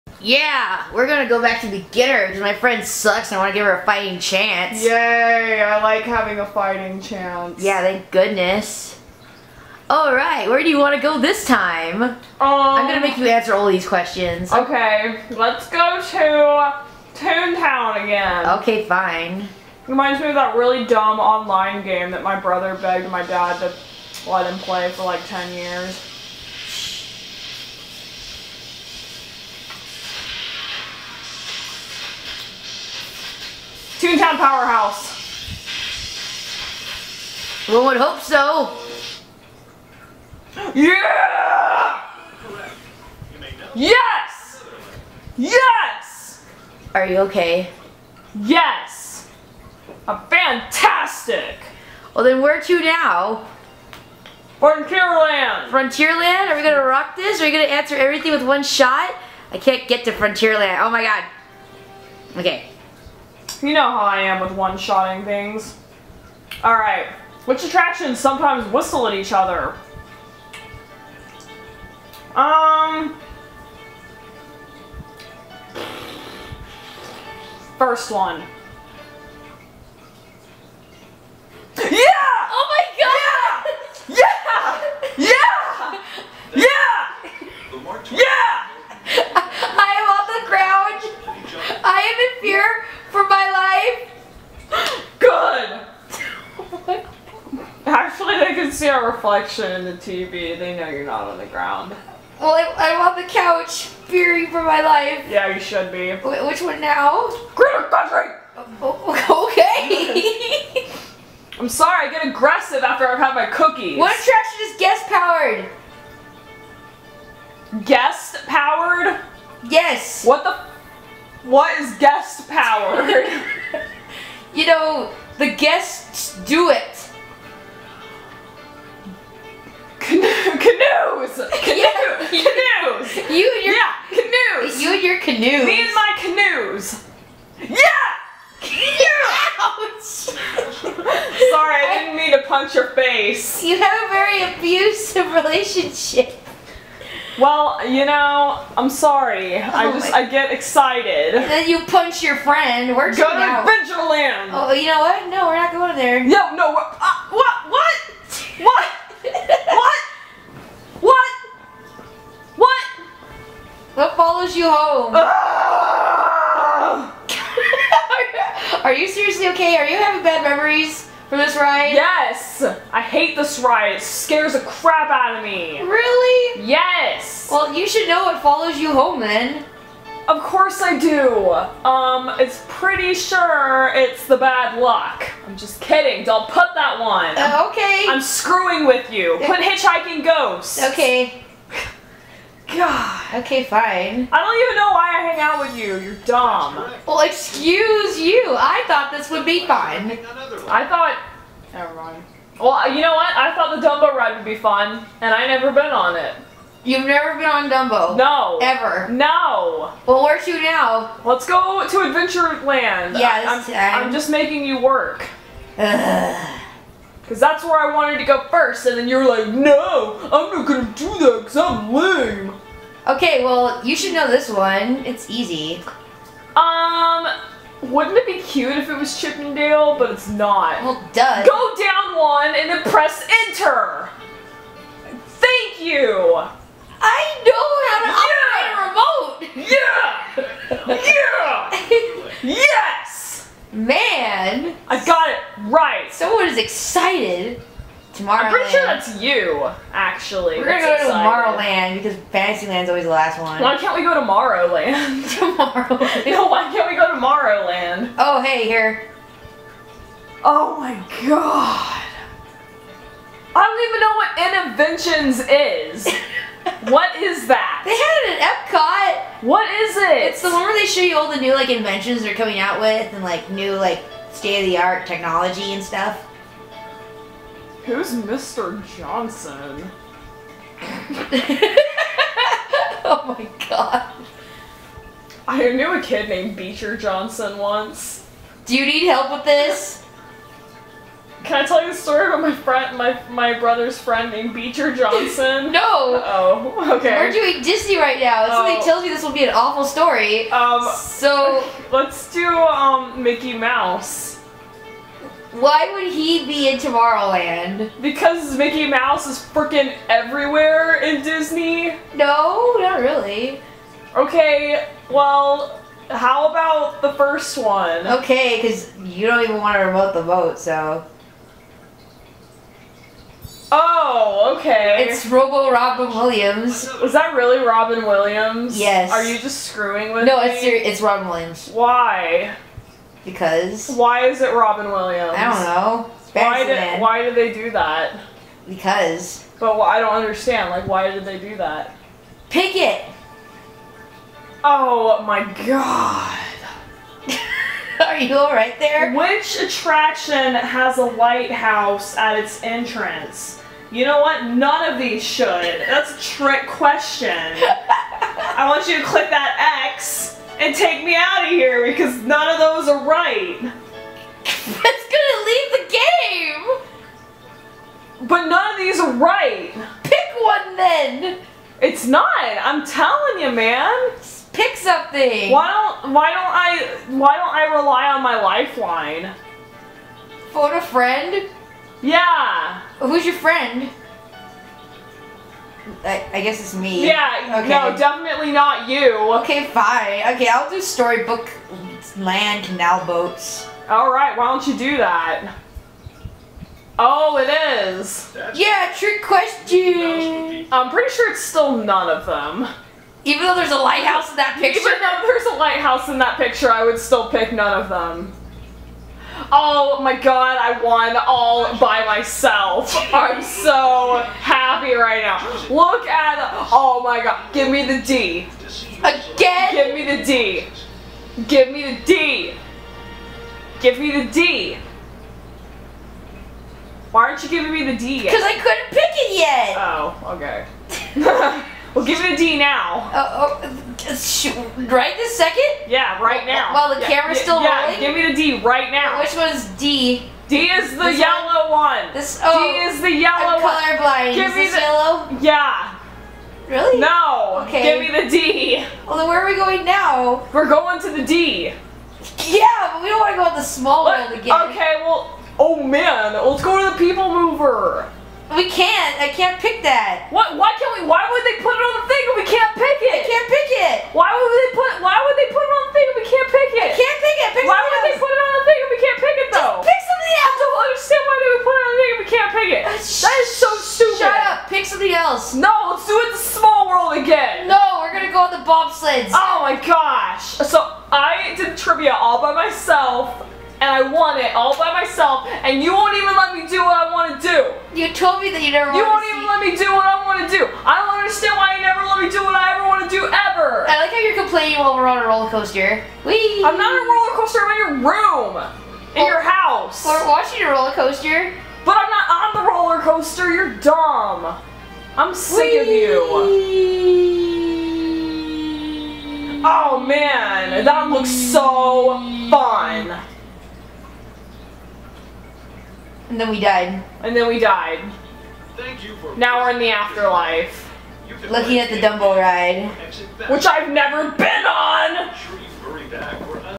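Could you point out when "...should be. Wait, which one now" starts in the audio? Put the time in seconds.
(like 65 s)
105 s.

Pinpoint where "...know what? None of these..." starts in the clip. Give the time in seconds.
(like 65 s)
354 s.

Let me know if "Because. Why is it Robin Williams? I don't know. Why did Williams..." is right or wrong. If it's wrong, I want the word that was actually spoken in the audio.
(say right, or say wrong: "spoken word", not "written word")
wrong: "Why", not "Williams".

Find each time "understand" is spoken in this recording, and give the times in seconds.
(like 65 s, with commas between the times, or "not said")
340 s, 491 s.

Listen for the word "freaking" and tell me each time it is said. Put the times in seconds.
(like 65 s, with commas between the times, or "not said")
309 s.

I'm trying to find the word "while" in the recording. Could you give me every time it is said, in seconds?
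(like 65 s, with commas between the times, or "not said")
436 s, 494 s.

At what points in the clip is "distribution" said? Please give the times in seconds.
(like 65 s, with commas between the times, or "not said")
not said.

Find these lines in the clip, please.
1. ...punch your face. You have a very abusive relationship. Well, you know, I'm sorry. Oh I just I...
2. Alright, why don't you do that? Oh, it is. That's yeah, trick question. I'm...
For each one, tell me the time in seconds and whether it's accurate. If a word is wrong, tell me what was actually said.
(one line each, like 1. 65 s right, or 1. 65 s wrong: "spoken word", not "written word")
1. 142 s right
2. 393 s right.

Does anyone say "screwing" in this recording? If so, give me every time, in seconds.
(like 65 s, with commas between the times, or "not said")
188 s, 329 s.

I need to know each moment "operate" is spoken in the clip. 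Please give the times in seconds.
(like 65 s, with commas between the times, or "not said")
240 s.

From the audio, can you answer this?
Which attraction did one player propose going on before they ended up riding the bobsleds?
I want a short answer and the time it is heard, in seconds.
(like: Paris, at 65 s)
People mover, at 457 s.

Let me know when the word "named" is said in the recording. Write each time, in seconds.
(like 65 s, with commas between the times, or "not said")
286 s, 294 s.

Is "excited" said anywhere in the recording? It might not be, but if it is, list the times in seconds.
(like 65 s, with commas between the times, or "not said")
150 s, 246 s, 250 s.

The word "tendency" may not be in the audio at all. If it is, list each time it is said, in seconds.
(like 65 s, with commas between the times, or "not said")
not said.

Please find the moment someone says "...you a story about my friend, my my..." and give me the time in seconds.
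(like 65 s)
291 s.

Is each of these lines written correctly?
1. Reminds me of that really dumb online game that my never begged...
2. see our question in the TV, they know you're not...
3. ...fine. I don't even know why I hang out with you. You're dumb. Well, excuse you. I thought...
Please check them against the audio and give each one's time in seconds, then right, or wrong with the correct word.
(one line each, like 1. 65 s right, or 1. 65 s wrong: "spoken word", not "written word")
1. 19 s wrong: "brother", not "never"
2. 98 s wrong: "reflection", not "question"
3. 193 s right.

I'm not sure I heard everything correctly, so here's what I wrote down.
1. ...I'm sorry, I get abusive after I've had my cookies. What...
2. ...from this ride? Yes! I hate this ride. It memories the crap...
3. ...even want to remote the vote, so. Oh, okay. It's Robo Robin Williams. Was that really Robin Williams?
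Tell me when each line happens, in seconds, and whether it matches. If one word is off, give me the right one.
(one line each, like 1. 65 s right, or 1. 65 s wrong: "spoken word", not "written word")
1. 111 s wrong: "aggressive", not "abusive"
2. 171 s wrong: "scares", not "memories"
3. 319 s right.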